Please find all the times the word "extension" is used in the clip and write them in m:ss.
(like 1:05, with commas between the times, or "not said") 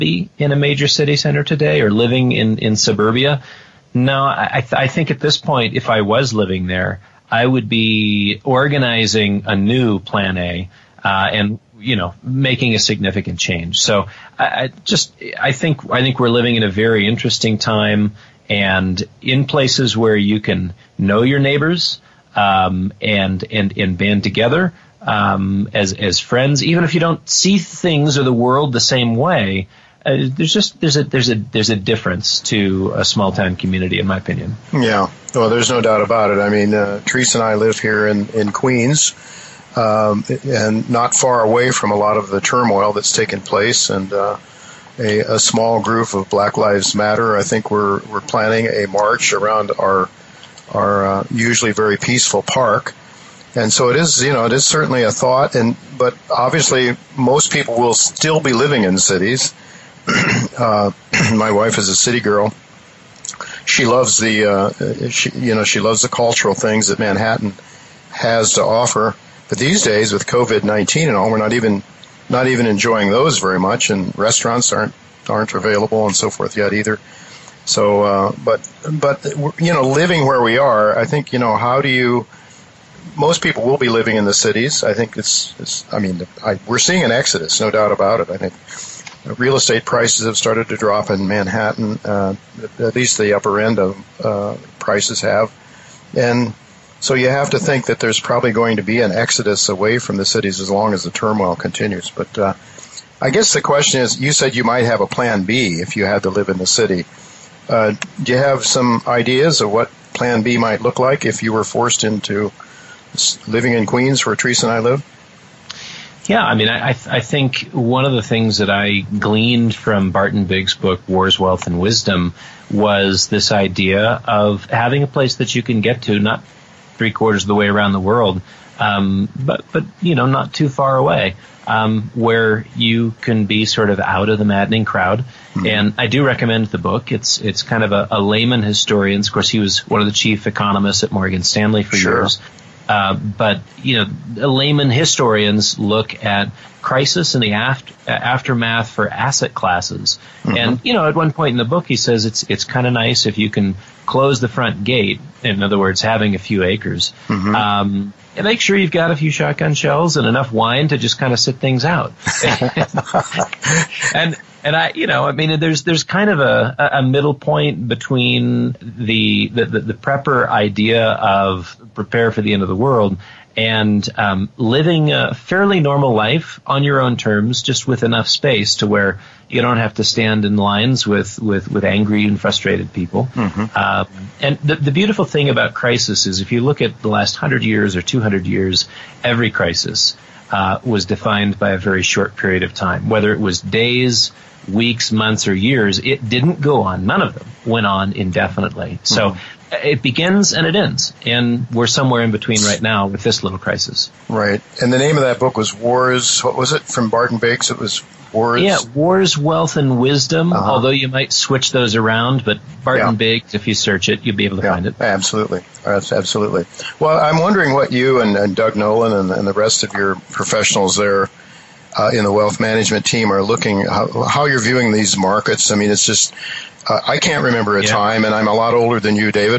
not said.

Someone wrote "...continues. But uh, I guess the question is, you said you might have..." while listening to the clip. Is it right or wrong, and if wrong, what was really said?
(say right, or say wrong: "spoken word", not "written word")
right.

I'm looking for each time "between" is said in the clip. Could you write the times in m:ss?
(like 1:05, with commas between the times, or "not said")
2:47, 3:22.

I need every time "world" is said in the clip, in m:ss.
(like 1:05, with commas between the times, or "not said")
0:28, 2:07, 2:52.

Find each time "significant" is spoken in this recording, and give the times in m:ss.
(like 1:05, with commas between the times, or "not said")
0:12.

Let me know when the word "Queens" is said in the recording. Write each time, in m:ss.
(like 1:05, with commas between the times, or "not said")
0:38, 1:53.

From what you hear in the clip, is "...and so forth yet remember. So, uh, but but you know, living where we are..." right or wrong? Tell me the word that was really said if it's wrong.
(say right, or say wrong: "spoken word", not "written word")
wrong: "either", not "remember".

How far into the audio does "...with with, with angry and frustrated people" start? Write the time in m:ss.
3:01.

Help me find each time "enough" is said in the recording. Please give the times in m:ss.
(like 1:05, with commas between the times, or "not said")
2:40, 2:58.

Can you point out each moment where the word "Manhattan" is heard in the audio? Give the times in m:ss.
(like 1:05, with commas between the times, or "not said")
1:06, 1:31.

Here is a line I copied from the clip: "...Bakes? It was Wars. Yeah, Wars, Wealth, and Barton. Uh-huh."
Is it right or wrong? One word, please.
wrong.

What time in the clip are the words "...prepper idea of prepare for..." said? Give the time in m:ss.
2:49.